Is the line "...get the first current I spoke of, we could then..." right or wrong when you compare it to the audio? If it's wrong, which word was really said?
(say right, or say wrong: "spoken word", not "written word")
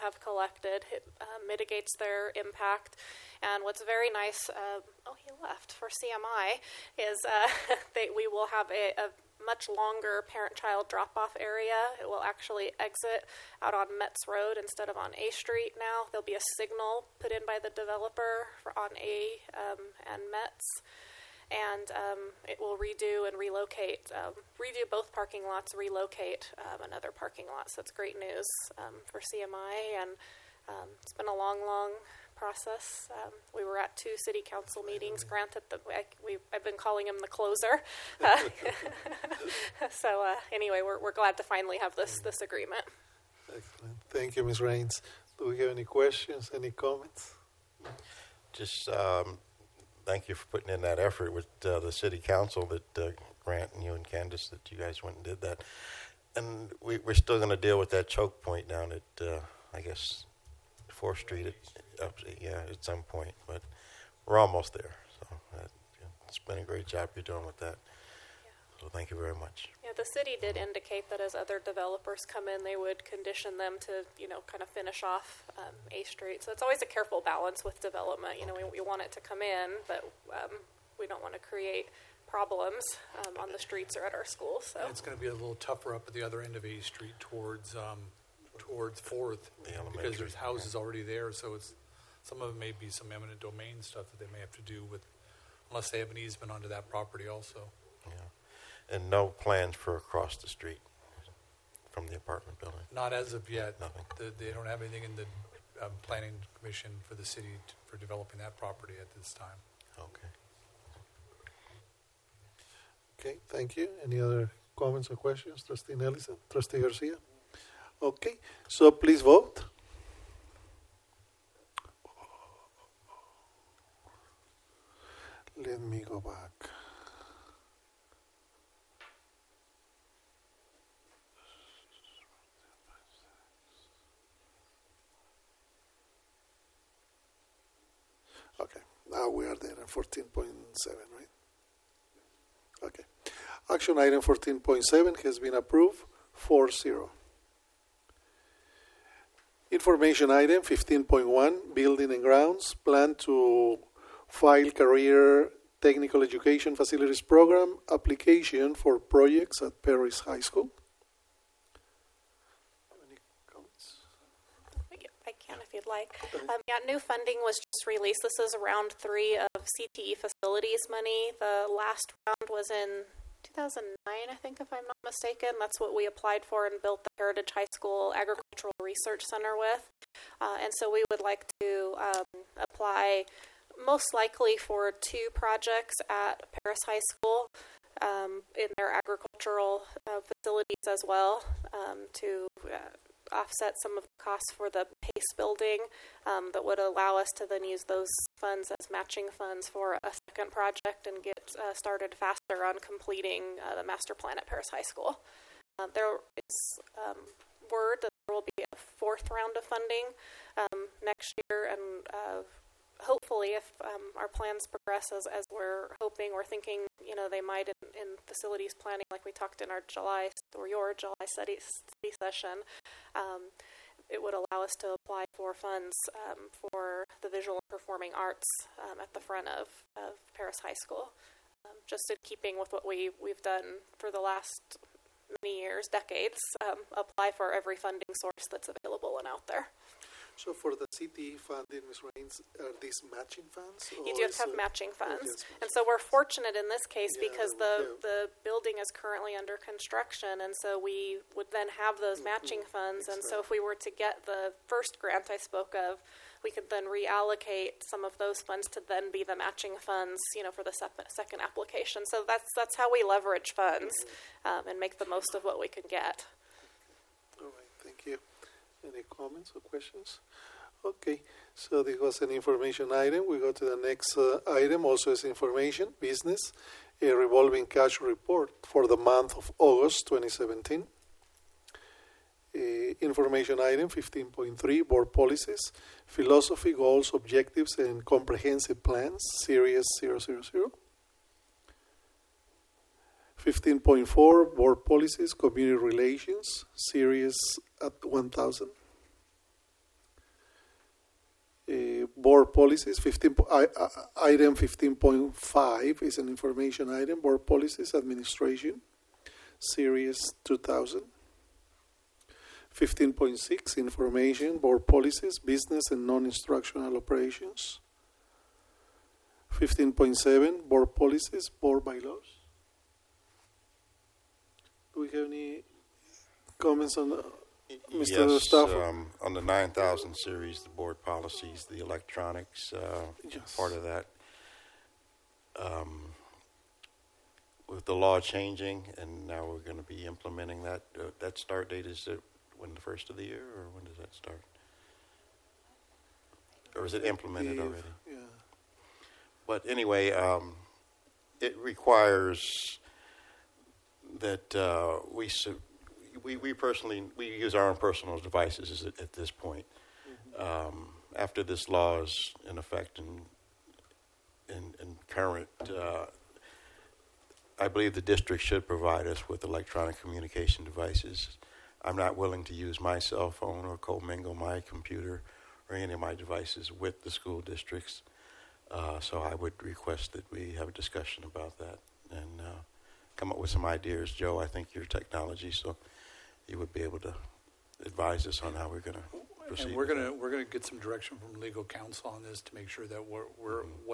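wrong: "grant", not "current".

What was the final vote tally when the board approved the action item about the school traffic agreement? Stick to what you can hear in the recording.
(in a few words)
4-0.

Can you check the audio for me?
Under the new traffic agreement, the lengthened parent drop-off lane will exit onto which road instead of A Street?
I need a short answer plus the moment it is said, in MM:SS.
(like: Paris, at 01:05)
Metz Road, at 00:13.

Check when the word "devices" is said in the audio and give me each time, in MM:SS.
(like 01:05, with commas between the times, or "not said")
05:58, 06:10, 06:16.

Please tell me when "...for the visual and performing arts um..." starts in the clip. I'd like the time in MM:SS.
03:46.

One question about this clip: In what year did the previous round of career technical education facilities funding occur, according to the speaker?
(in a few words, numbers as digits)
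2009.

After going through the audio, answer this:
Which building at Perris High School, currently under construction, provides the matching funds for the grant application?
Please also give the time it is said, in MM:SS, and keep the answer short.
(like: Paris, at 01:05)
PACE building, at 03:14.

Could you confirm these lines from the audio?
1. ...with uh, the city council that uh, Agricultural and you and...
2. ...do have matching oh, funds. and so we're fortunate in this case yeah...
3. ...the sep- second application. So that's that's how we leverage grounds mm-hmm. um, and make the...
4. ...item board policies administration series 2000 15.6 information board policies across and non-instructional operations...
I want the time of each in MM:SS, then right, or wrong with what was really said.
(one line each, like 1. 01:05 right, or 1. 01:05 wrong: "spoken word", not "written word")
1. 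00:51 wrong: "Grant", not "Agricultural"
2. 04:04 right
3. 04:20 wrong: "funds", not "grounds"
4. 05:06 wrong: "business", not "across".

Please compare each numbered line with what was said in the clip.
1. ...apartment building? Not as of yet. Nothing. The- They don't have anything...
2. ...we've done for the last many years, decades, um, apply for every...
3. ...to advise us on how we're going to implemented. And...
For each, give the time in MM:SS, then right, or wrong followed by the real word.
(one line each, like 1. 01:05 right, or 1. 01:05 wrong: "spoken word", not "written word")
1. 01:42 right
2. 03:53 right
3. 06:26 wrong: "proceed", not "implemented".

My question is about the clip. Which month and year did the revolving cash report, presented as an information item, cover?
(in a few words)
August 2017.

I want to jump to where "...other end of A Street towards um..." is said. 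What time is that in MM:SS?
01:26.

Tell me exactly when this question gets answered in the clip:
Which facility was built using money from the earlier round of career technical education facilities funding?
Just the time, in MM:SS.
02:57.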